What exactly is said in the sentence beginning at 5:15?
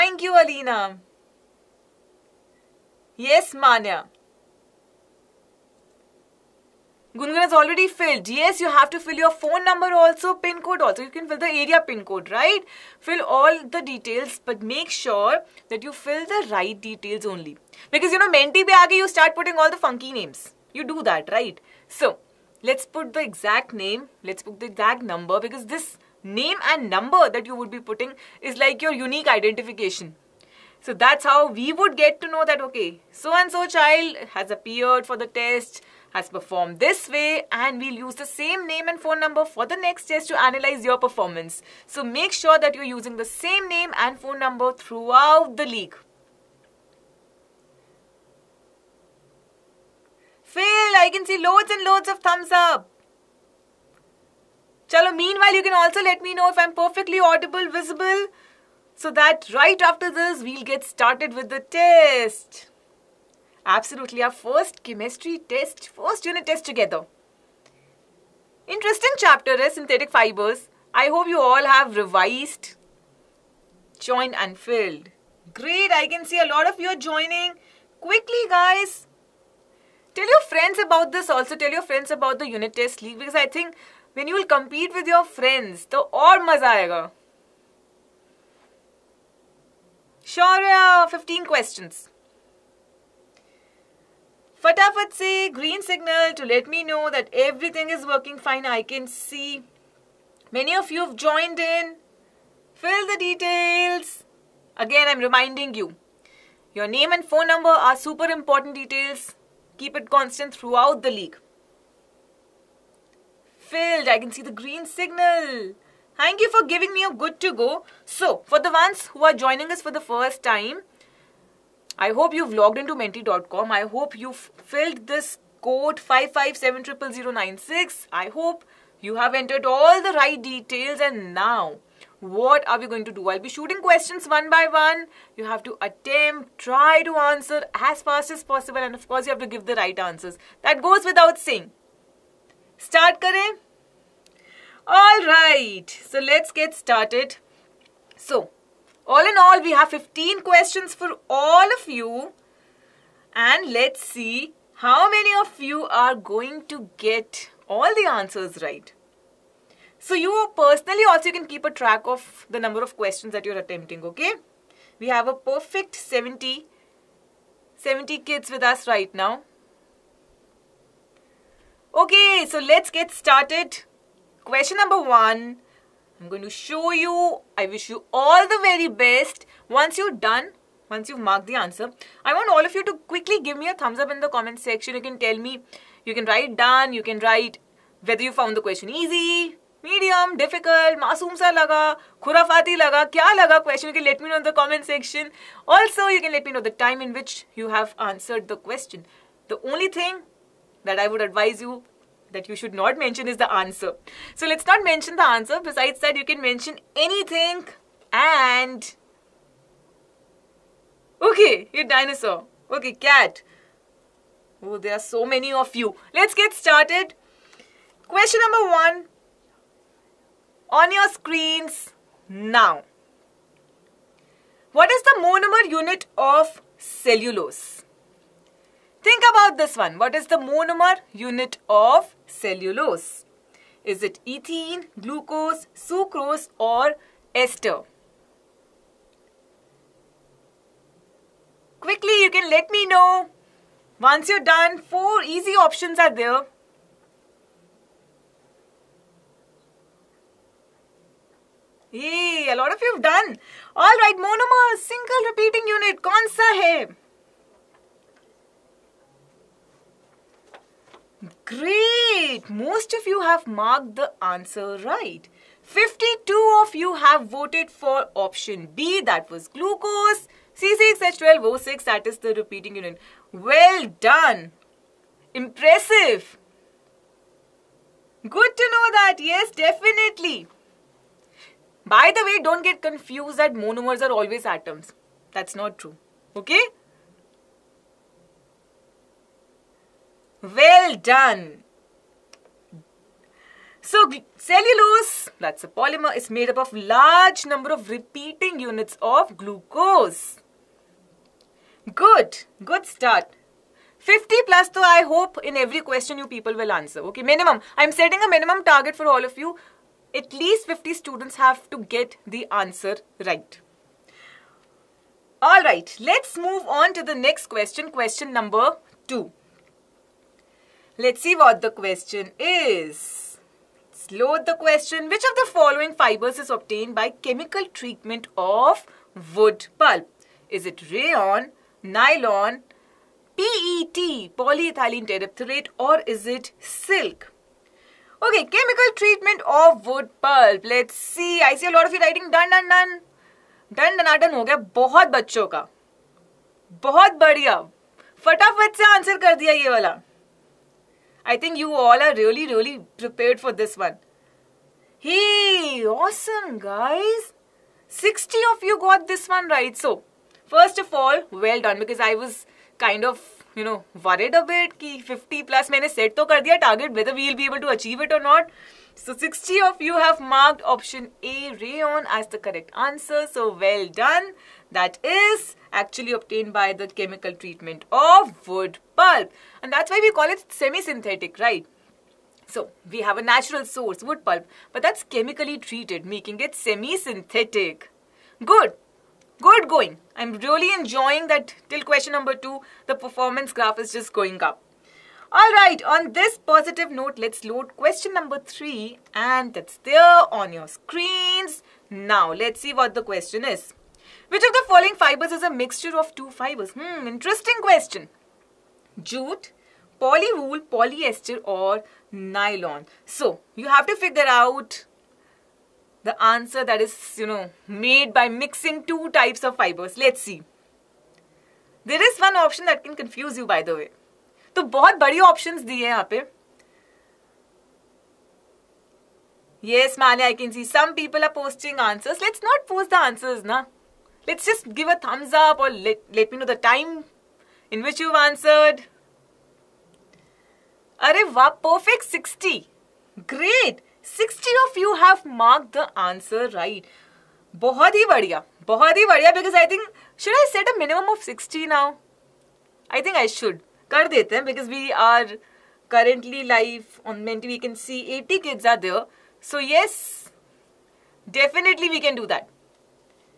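Alright, let's move on to the next question, question number 2.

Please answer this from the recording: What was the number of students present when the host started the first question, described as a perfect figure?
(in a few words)
70.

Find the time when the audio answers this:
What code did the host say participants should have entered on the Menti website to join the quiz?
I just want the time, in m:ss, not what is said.
2:05.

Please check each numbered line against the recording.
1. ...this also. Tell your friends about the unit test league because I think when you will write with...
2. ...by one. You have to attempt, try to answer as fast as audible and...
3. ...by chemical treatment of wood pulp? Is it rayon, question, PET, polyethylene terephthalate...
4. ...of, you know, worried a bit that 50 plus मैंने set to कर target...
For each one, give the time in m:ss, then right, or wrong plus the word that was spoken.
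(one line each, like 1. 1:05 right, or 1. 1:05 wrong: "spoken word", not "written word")
1. 1:21 wrong: "compete", not "write"
2. 2:14 wrong: "possible", not "audible"
3. 5:26 wrong: "nylon", not "question"
4. 6:03 right.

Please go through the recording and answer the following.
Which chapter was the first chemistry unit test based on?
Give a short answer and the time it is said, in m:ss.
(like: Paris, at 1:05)
Synthetic fibers, at 1:09.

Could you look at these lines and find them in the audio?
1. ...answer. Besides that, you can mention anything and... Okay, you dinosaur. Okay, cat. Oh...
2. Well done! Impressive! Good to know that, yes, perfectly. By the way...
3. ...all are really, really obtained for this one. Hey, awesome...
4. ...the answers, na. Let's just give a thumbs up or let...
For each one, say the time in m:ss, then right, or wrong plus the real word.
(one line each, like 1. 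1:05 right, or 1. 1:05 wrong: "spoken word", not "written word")
1. 3:25 right
2. 4:33 wrong: "definitely", not "perfectly"
3. 5:51 wrong: "prepared", not "obtained"
4. 7:12 right.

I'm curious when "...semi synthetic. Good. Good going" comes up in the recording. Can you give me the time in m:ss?
6:26.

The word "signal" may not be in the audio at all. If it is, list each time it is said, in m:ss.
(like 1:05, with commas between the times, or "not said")
1:35, 1:54.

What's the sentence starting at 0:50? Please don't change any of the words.
Phil, I can see loads and loads of thumbs up.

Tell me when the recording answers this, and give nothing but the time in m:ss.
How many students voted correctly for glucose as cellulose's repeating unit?
4:25.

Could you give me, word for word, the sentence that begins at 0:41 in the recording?
So make sure that you're using the same name and phone number throughout the league.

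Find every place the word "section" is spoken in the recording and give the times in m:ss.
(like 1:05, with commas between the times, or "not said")
3:04, 3:14.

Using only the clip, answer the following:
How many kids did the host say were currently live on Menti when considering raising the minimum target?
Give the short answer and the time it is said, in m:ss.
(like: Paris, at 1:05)
80, at 7:38.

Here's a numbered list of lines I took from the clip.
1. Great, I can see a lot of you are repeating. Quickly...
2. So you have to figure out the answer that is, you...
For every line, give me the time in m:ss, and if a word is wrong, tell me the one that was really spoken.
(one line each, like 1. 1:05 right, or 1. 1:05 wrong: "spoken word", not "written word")
1. 1:15 wrong: "joining", not "repeating"
2. 6:53 right.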